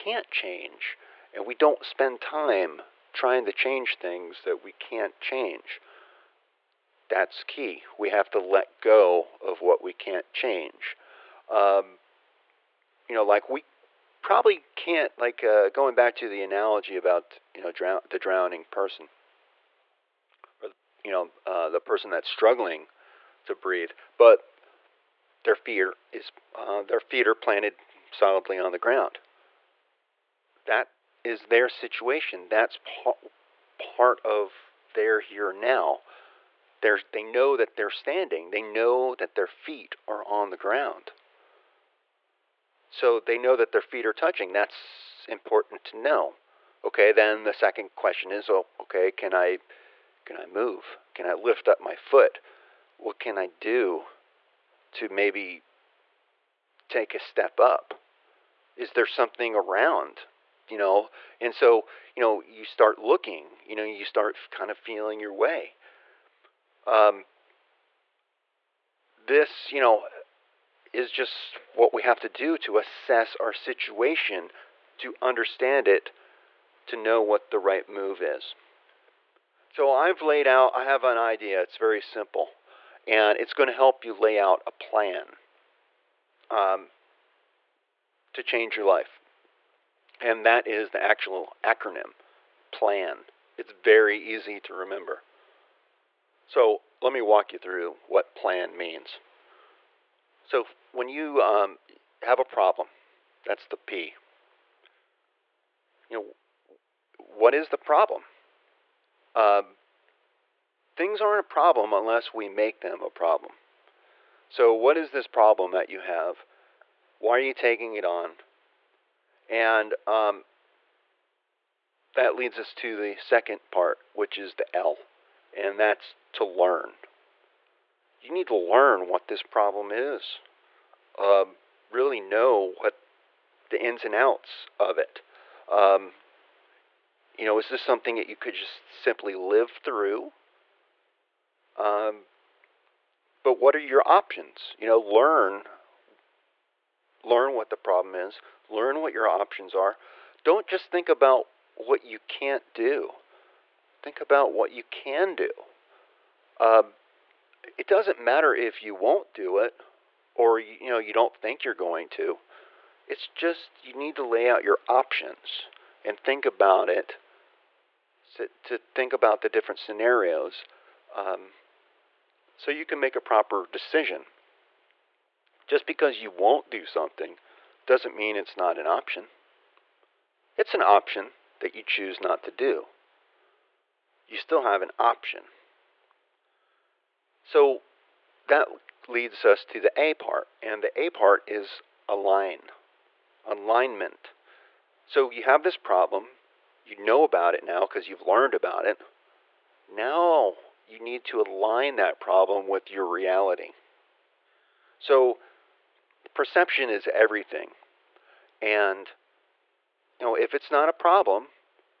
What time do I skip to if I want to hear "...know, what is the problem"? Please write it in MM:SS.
01:46.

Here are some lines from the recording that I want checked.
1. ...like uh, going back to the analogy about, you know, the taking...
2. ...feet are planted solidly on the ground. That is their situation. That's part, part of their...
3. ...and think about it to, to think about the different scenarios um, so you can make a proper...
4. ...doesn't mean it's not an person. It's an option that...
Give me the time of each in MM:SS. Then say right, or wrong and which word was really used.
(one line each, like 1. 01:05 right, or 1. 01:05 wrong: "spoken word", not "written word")
1. 00:15 wrong: "drowning", not "taking"
2. 00:26 right
3. 02:46 right
4. 02:57 wrong: "option", not "person".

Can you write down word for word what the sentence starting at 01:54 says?
So, what is this problem that you have?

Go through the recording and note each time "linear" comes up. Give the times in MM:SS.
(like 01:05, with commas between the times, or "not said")
not said.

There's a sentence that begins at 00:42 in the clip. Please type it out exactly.
So they know that their feet are touching.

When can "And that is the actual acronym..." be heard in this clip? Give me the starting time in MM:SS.
01:30.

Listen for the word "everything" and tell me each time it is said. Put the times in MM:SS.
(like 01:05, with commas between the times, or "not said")
03:27.